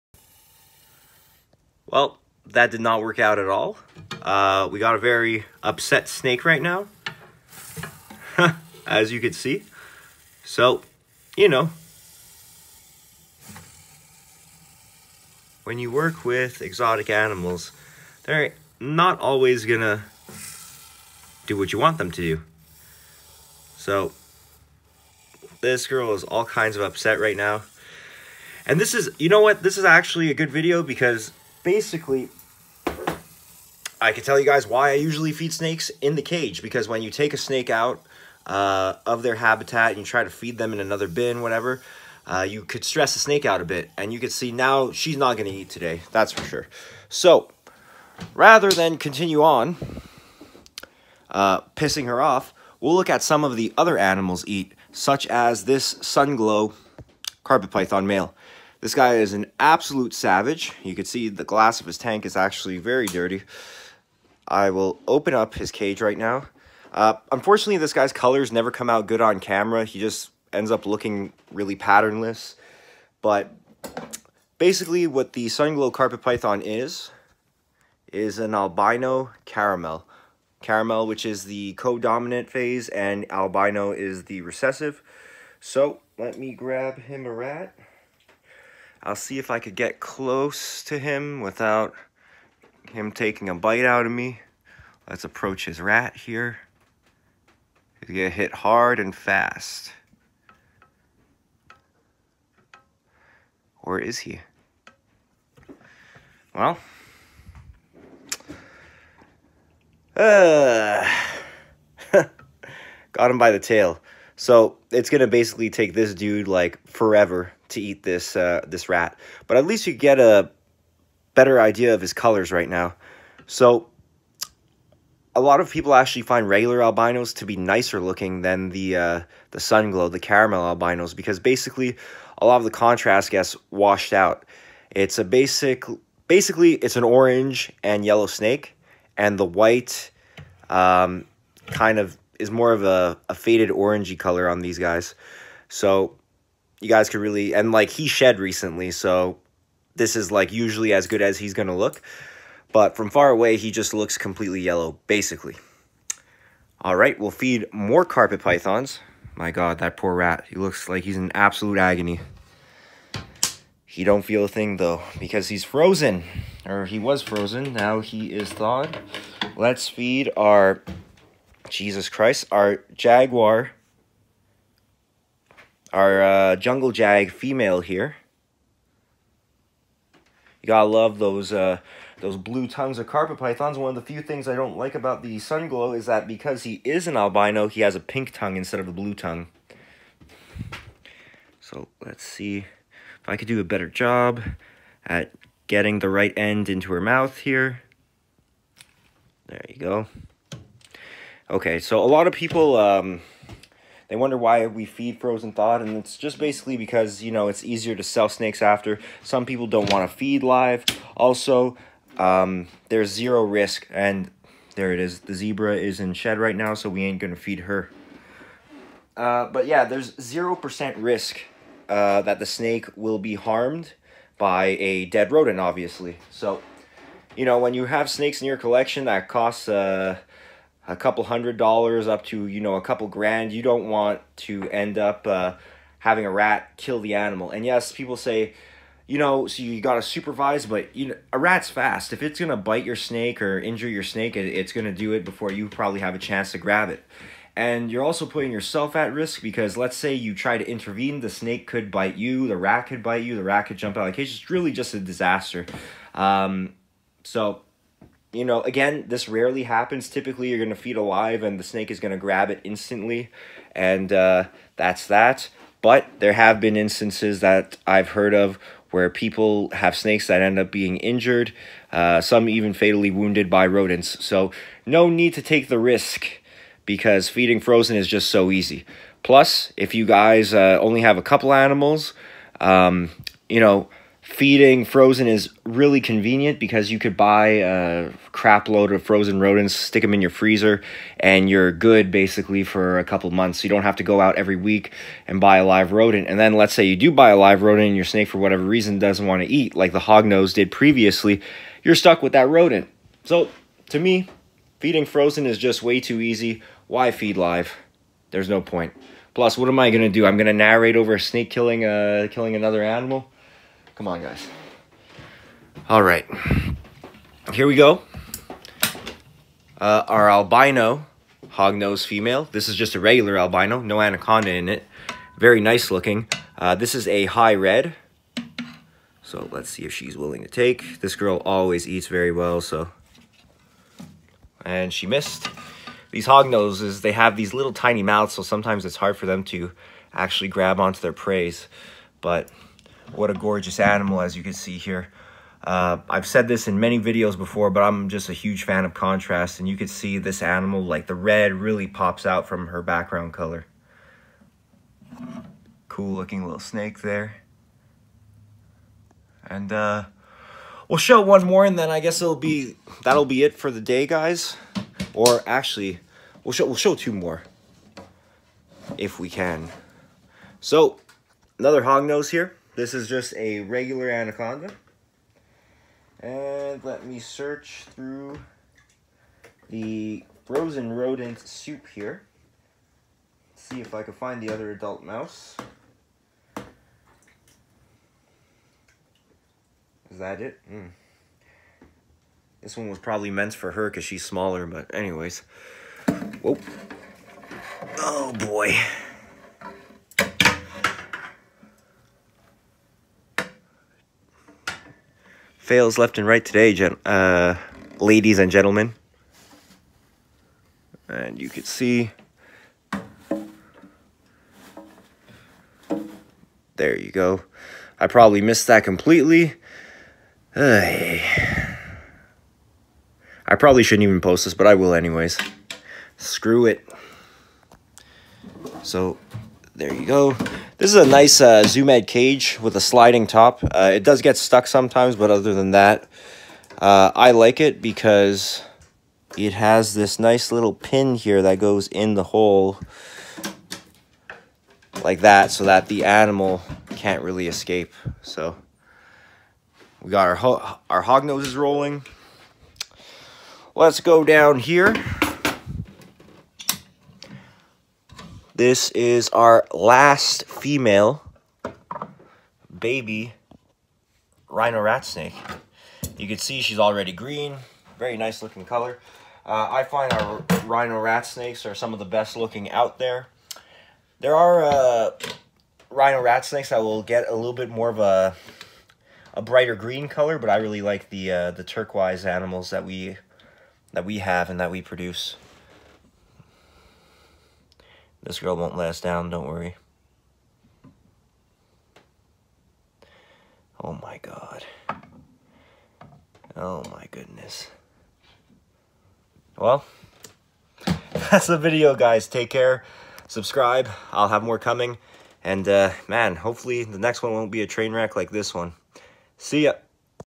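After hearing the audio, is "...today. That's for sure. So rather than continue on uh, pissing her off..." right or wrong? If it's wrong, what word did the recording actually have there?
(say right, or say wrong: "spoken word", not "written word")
right.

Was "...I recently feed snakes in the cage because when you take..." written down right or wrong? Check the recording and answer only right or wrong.
wrong.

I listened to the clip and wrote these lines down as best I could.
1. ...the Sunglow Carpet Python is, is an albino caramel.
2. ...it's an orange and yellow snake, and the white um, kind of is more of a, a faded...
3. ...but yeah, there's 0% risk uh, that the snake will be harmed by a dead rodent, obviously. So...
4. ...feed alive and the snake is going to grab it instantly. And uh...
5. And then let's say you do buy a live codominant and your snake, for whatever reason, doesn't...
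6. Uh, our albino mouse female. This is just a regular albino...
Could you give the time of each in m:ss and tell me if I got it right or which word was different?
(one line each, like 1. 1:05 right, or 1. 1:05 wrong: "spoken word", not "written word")
1. 1:15 right
2. 2:16 right
3. 3:39 right
4. 4:20 right
5. 4:56 wrong: "rodent", not "codominant"
6. 5:19 wrong: "hognose", not "mouse".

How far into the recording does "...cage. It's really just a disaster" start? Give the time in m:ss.
4:14.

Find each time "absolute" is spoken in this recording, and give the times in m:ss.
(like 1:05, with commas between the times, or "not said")
0:59, 2:41.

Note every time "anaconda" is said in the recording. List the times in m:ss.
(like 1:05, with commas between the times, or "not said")
5:24, 6:14.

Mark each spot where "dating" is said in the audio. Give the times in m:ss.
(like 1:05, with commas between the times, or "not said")
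not said.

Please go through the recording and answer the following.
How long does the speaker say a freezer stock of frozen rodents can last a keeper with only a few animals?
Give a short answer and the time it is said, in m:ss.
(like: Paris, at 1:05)
A couple months, at 4:52.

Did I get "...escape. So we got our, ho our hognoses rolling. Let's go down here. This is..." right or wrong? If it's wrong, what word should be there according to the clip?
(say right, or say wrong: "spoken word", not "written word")
right.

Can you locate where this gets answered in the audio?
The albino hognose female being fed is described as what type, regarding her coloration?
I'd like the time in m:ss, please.
5:27.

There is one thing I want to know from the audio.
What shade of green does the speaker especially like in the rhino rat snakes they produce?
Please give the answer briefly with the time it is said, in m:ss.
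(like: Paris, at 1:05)
Turquoise, at 8:01.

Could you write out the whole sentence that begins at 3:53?
You don't want to end up uh, having a rat kill the animal.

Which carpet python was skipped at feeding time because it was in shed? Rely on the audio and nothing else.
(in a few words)
The zebra.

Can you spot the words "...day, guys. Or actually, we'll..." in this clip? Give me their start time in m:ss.
6:03.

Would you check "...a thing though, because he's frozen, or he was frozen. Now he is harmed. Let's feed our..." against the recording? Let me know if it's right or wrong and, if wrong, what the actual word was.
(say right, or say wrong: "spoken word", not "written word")
wrong: "thawed", not "harmed".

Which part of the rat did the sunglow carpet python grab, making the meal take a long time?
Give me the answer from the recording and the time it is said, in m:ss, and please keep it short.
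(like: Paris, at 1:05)
The tail, at 1:53.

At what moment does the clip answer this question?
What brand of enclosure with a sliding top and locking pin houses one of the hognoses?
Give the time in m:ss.
7:11.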